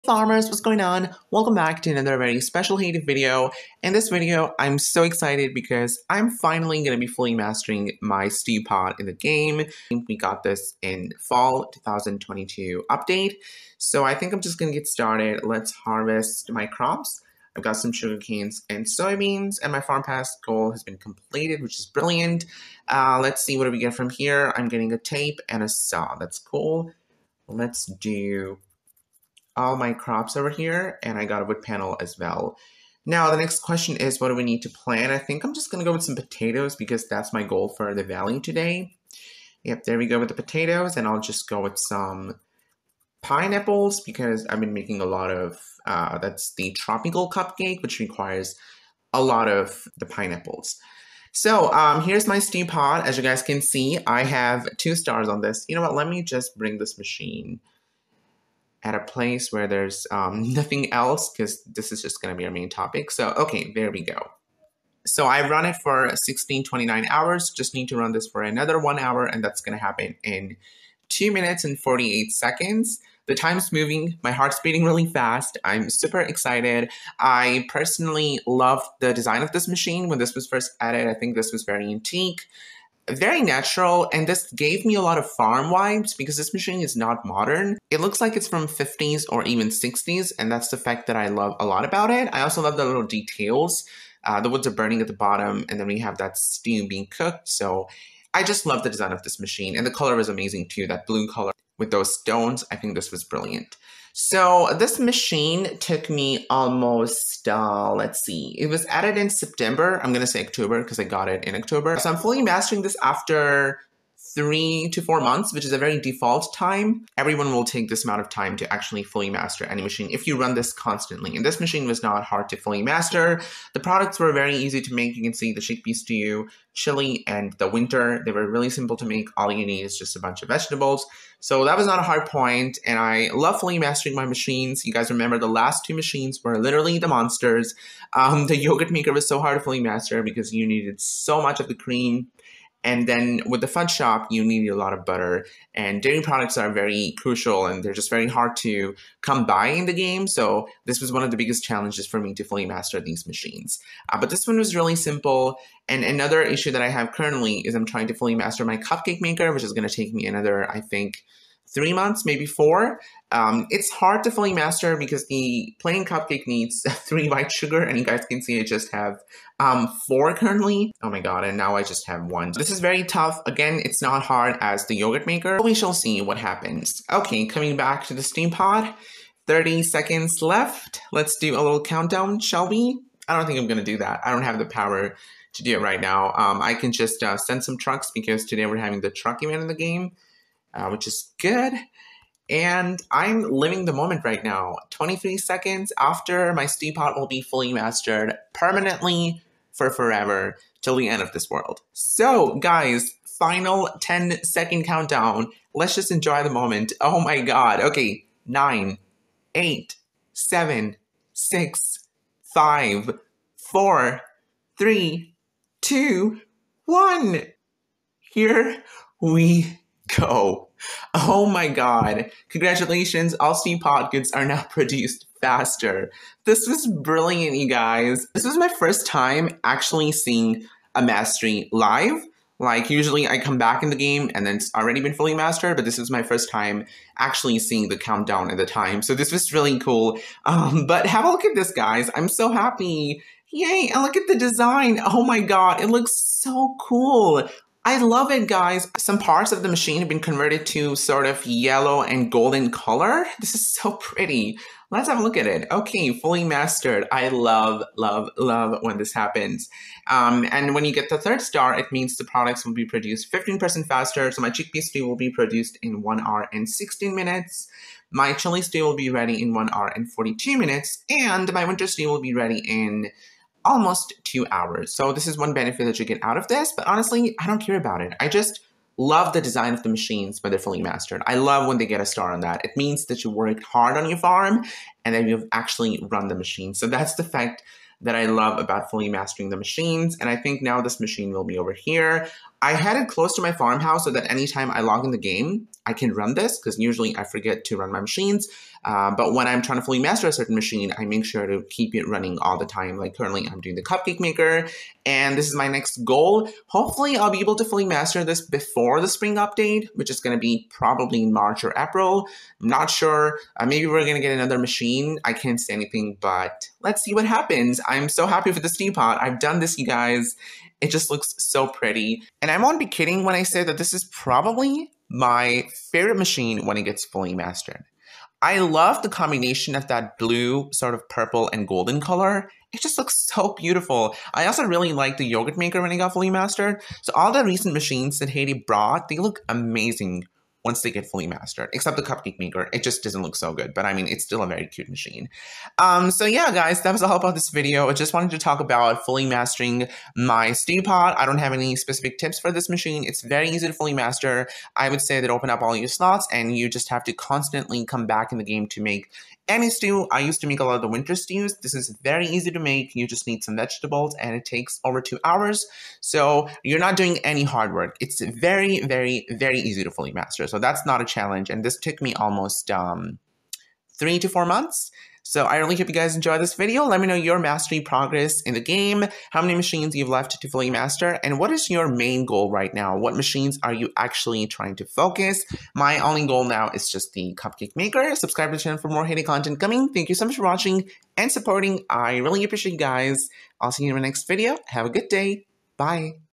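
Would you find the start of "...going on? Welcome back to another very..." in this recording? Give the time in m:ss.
0:00.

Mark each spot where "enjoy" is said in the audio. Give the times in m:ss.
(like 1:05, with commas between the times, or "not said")
3:26, 6:16.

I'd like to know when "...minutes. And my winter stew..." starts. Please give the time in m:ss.
4:30.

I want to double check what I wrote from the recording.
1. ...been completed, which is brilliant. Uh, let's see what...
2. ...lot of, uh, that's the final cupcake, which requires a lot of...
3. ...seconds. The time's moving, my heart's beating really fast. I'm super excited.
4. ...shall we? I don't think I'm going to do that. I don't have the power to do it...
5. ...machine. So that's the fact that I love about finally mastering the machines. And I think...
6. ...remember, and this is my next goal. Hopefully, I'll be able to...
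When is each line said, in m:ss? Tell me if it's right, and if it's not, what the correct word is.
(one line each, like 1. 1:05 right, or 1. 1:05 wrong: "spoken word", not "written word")
1. 0:20 right
2. 0:45 wrong: "tropical", not "final"
3. 1:12 right
4. 3:02 right
5. 4:46 wrong: "fully", not "finally"
6. 5:04 wrong: "maker", not "remember".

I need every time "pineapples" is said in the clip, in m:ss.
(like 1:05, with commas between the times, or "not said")
0:43, 0:50.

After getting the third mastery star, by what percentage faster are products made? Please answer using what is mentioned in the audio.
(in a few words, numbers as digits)
15%.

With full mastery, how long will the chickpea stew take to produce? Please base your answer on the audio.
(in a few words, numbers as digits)
1 hour 16 minutes.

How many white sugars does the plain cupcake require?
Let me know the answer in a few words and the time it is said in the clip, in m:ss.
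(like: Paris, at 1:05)
3, at 2:47.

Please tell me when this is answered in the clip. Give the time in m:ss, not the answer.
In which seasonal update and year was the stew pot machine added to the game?
0:11.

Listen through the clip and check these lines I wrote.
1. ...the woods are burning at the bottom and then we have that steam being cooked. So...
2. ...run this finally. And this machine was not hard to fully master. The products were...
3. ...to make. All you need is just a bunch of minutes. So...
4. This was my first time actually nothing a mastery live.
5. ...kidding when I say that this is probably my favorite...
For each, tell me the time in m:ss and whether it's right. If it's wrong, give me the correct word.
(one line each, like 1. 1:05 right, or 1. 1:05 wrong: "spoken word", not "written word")
1. 1:34 right
2. 2:00 wrong: "constantly", not "finally"
3. 2:08 wrong: "vegetables", not "minutes"
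4. 3:48 wrong: "seeing", not "nothing"
5. 5:22 right.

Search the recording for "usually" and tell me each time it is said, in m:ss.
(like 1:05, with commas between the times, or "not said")
3:52, 4:56.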